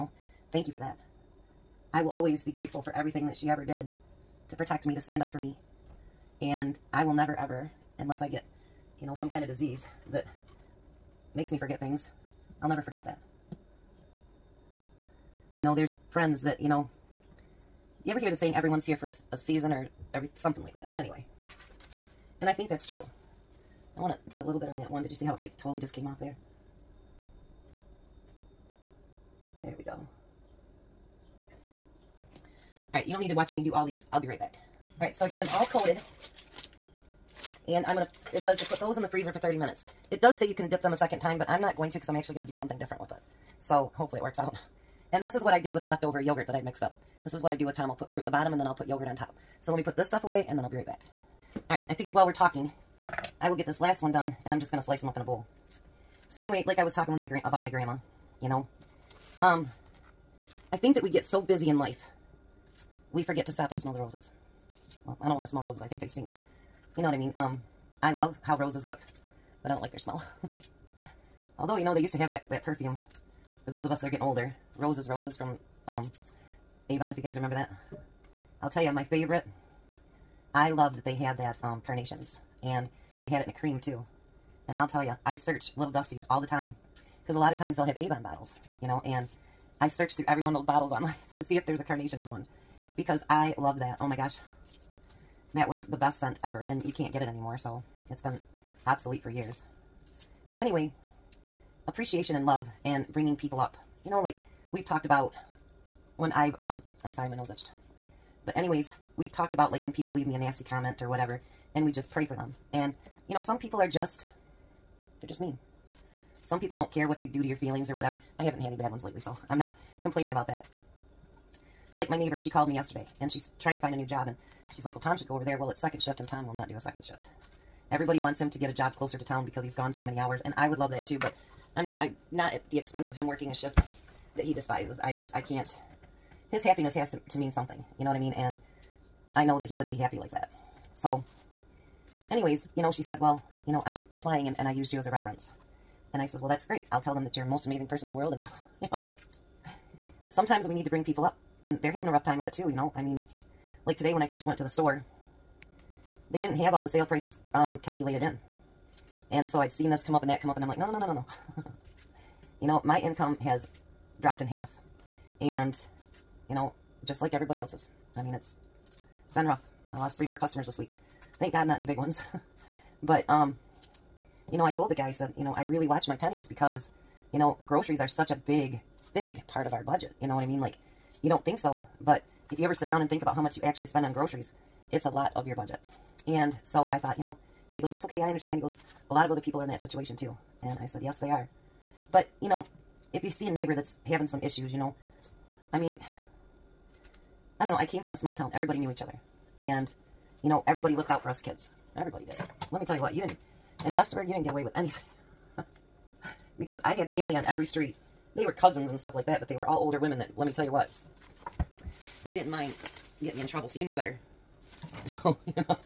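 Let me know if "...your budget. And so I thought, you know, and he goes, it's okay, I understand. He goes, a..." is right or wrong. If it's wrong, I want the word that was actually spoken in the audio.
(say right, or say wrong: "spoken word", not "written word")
right.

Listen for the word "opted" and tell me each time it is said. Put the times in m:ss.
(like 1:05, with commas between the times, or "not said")
not said.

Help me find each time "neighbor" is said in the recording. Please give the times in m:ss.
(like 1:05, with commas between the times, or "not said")
2:02, 3:13.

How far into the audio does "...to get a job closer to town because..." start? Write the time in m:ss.
2:08.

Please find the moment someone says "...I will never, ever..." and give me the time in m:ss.
0:06.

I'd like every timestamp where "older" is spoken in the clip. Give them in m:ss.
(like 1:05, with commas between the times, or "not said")
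1:14, 3:29.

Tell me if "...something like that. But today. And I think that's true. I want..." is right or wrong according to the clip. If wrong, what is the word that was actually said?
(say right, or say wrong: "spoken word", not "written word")
wrong: "anyway", not "today".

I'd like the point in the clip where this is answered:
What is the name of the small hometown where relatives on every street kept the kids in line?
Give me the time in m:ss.
3:23.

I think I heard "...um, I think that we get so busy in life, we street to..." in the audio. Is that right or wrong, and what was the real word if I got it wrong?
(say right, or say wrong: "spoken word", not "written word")
wrong: "forget", not "street".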